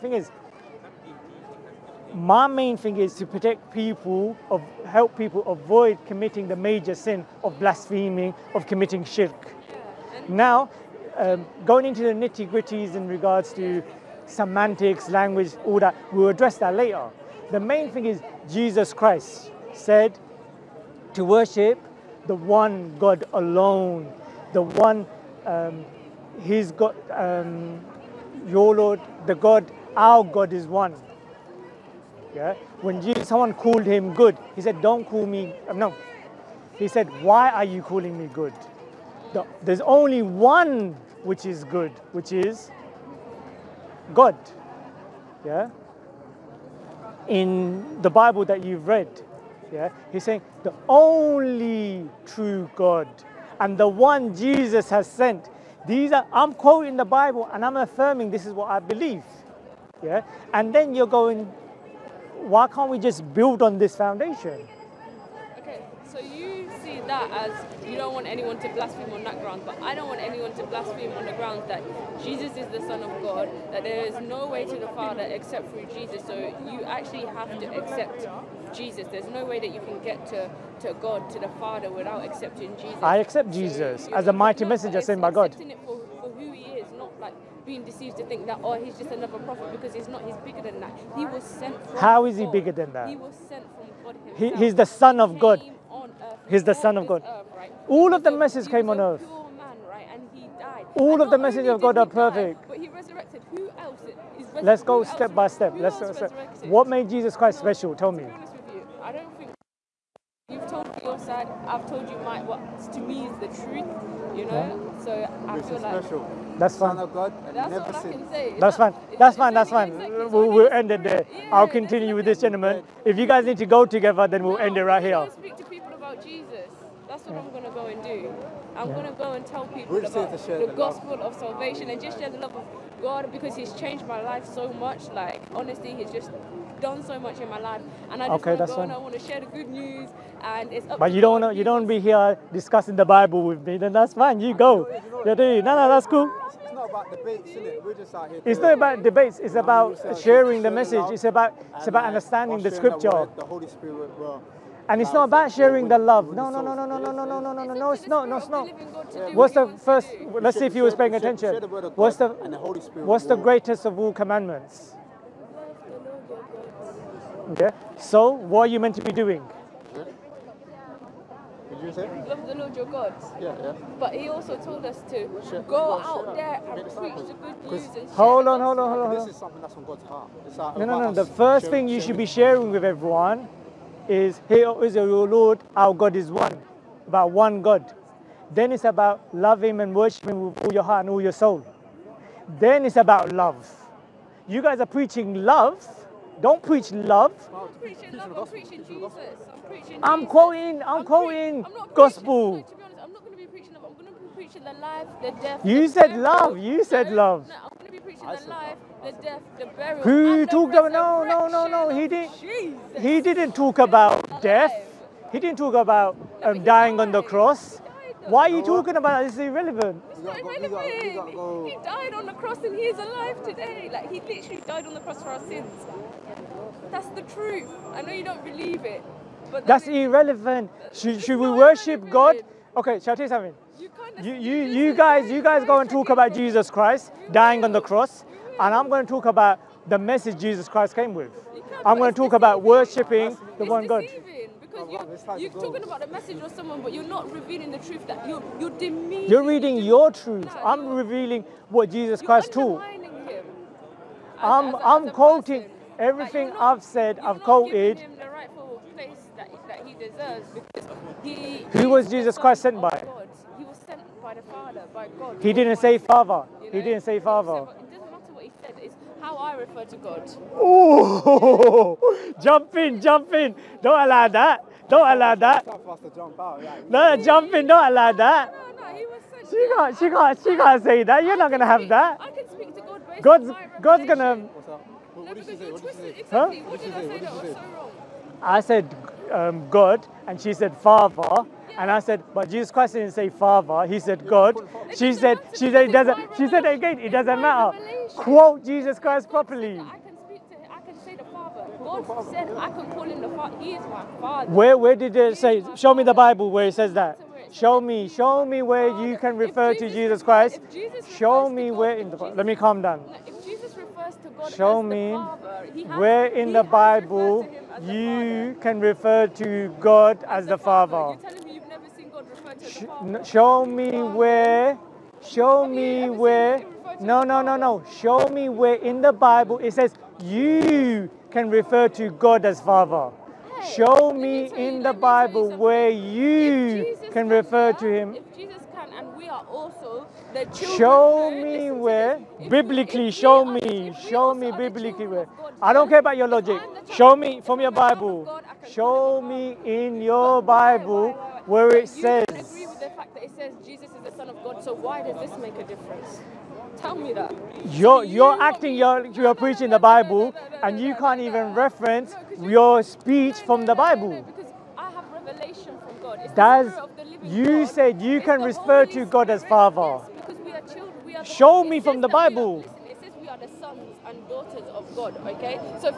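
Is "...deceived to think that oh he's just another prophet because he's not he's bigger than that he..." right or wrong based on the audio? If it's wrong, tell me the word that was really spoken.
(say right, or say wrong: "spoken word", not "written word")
right.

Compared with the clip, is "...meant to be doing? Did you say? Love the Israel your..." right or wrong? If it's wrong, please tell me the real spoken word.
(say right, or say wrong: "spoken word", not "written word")
wrong: "Lord", not "Israel".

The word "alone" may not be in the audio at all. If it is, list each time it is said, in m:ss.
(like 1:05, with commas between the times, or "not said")
0:23.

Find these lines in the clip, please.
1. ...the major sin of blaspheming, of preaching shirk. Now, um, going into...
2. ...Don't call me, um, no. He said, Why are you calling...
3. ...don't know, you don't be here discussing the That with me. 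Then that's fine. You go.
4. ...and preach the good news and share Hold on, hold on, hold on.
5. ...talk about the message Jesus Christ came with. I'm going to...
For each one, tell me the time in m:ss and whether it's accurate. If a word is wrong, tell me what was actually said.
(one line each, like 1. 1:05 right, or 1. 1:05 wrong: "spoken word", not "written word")
1. 0:06 wrong: "committing", not "preaching"
2. 0:34 right
3. 2:21 wrong: "Bible", not "That"
4. 2:56 right
5. 3:59 right.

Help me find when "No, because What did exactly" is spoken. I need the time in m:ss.
4:44.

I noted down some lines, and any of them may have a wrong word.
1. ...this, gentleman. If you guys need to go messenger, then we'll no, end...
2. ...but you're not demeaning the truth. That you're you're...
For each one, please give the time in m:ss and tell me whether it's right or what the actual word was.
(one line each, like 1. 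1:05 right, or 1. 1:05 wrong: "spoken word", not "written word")
1. 2:02 wrong: "together", not "messenger"
2. 4:06 wrong: "revealing", not "demeaning".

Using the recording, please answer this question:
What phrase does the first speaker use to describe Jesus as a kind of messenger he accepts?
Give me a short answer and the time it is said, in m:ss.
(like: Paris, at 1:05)
a mighty messenger, at 1:24.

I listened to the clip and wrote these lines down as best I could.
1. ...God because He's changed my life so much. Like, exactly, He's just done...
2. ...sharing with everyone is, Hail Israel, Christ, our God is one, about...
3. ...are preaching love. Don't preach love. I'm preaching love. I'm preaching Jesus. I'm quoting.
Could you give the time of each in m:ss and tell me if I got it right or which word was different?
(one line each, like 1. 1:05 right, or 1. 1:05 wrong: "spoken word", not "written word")
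1. 2:13 wrong: "honestly", not "exactly"
2. 3:02 wrong: "Lord", not "Christ"
3. 3:14 right.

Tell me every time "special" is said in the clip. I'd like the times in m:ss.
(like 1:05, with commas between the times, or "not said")
1:47, 1:56.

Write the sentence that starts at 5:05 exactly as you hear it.
Show me the Bible where it says that.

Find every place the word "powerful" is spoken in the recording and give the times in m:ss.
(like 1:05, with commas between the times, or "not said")
not said.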